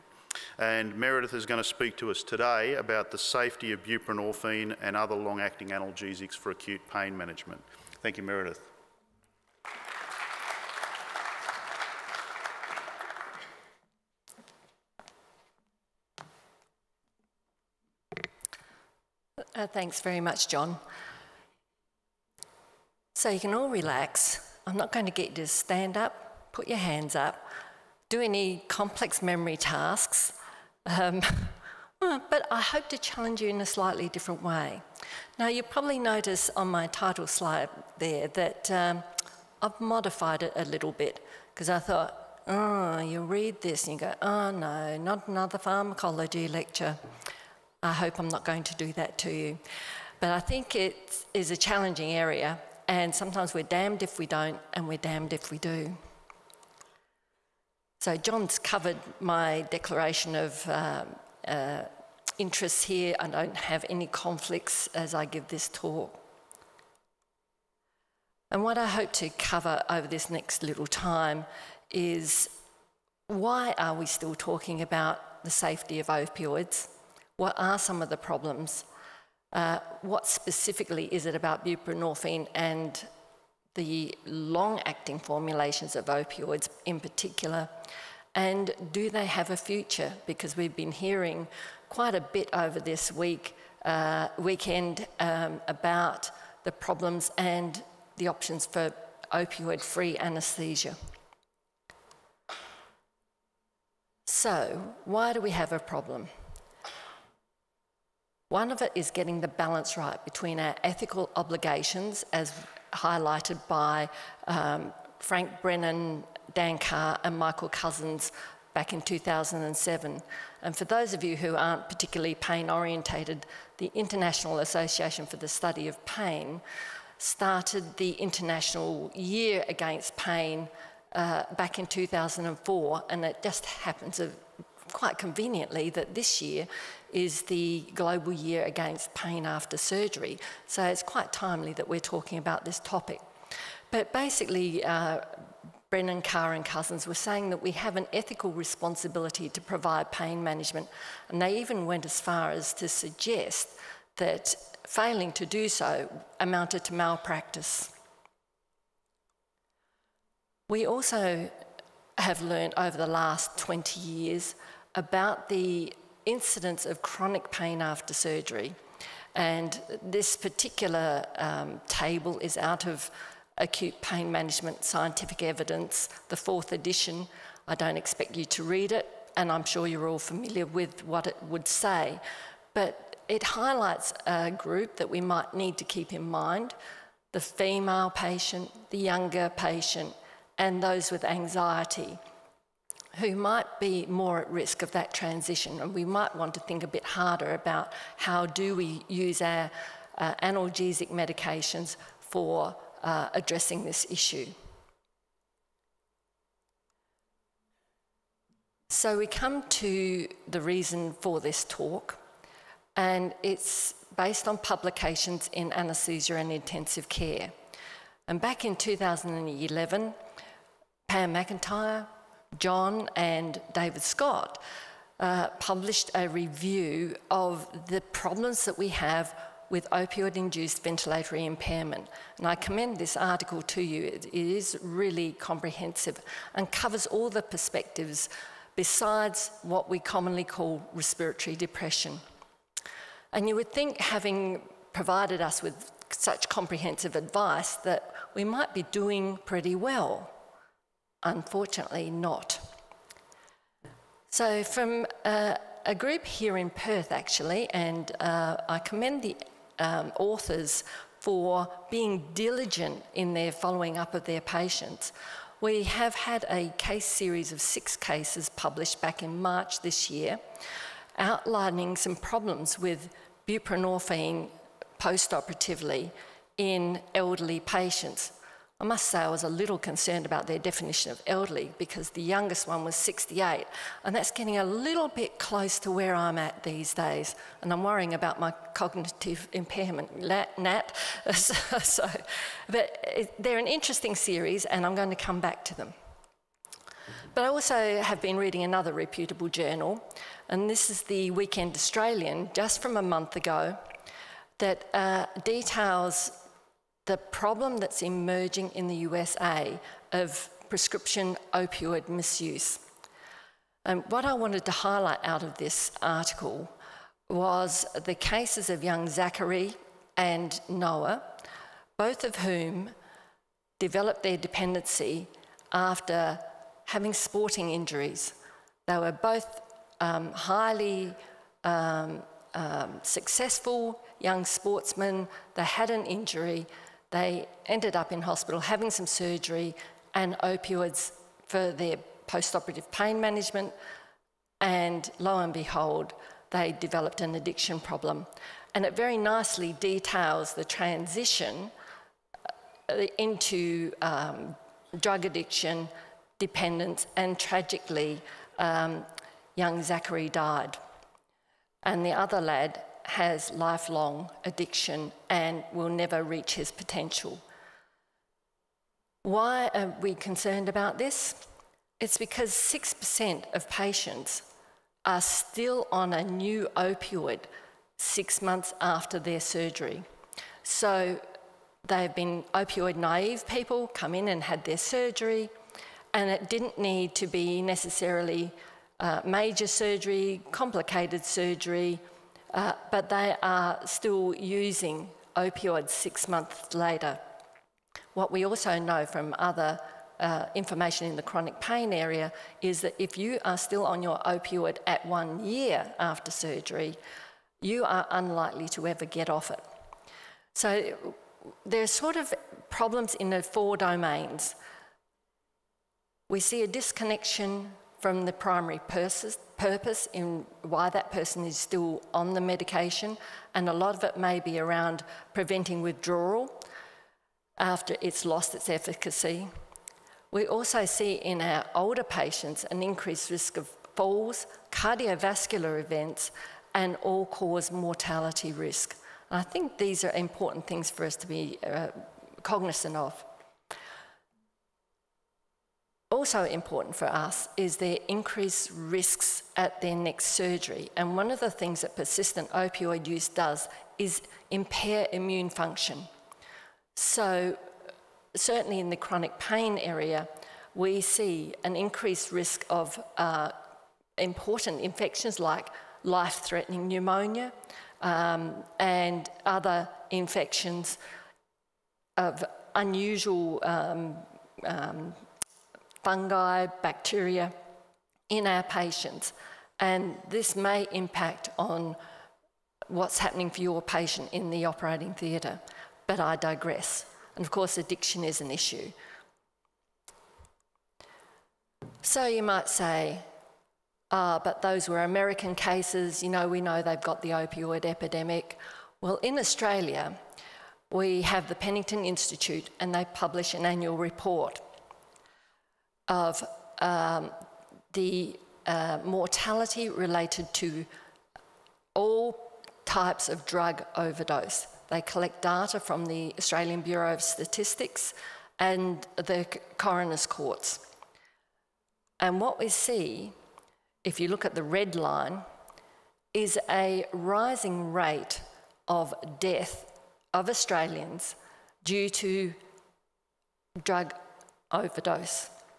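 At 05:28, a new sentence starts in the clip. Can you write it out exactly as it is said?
They were both um, highly um, um, successful young sportsmen.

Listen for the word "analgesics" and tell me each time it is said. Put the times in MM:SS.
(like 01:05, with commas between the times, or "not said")
00:05, 03:20.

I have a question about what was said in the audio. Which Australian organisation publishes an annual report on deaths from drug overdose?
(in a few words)
Pennington Institute.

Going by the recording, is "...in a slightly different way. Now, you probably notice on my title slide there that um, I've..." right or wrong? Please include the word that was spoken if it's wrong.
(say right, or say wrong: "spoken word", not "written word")
right.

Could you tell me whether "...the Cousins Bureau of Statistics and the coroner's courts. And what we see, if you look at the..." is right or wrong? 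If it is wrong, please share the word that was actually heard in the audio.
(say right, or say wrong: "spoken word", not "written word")
wrong: "Australian", not "Cousins".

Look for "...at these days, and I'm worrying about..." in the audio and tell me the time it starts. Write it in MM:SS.
04:46.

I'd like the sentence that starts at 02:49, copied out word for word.
And this particular um, table is out of Acute Pain Management Scientific Evidence, the fourth edition.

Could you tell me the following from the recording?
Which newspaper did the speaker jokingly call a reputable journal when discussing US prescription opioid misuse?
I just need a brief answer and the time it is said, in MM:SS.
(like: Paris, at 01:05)
The Weekend Australian, at 05:01.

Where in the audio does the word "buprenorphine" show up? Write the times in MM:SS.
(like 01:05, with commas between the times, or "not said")
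00:03, 01:21, 04:33.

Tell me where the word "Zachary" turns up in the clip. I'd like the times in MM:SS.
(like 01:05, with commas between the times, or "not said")
05:19, 05:59.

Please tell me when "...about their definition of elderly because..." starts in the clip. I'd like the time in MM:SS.
04:40.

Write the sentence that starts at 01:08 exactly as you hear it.
And what I hope to cover over this next little time is why are we still talking about the safety of opioids?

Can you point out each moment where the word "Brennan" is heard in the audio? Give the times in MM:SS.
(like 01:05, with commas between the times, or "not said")
01:55, 02:25.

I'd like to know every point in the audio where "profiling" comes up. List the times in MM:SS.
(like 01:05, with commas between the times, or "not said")
not said.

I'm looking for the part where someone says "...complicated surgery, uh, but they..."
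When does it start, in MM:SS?
06:30.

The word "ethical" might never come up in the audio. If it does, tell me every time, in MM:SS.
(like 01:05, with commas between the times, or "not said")
01:50, 02:28.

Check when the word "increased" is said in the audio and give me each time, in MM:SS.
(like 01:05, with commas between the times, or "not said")
07:12, 07:28, 07:41.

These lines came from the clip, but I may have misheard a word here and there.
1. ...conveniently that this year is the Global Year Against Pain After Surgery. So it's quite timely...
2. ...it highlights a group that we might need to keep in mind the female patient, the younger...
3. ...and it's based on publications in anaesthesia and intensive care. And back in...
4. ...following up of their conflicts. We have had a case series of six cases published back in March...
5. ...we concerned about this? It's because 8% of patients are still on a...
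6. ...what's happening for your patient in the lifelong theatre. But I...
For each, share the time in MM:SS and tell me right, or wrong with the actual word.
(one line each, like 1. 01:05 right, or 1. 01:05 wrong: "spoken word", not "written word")
1. 02:15 right
2. 03:03 right
3. 03:32 right
4. 04:23 wrong: "patients", not "conflicts"
5. 06:10 wrong: "6", not "8"
6. 08:02 wrong: "operating", not "lifelong".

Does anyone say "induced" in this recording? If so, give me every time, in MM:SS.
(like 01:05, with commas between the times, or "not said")
03:50.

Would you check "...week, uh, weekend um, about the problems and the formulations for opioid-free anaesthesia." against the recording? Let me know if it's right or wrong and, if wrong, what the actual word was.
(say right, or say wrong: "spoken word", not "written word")
wrong: "options", not "formulations".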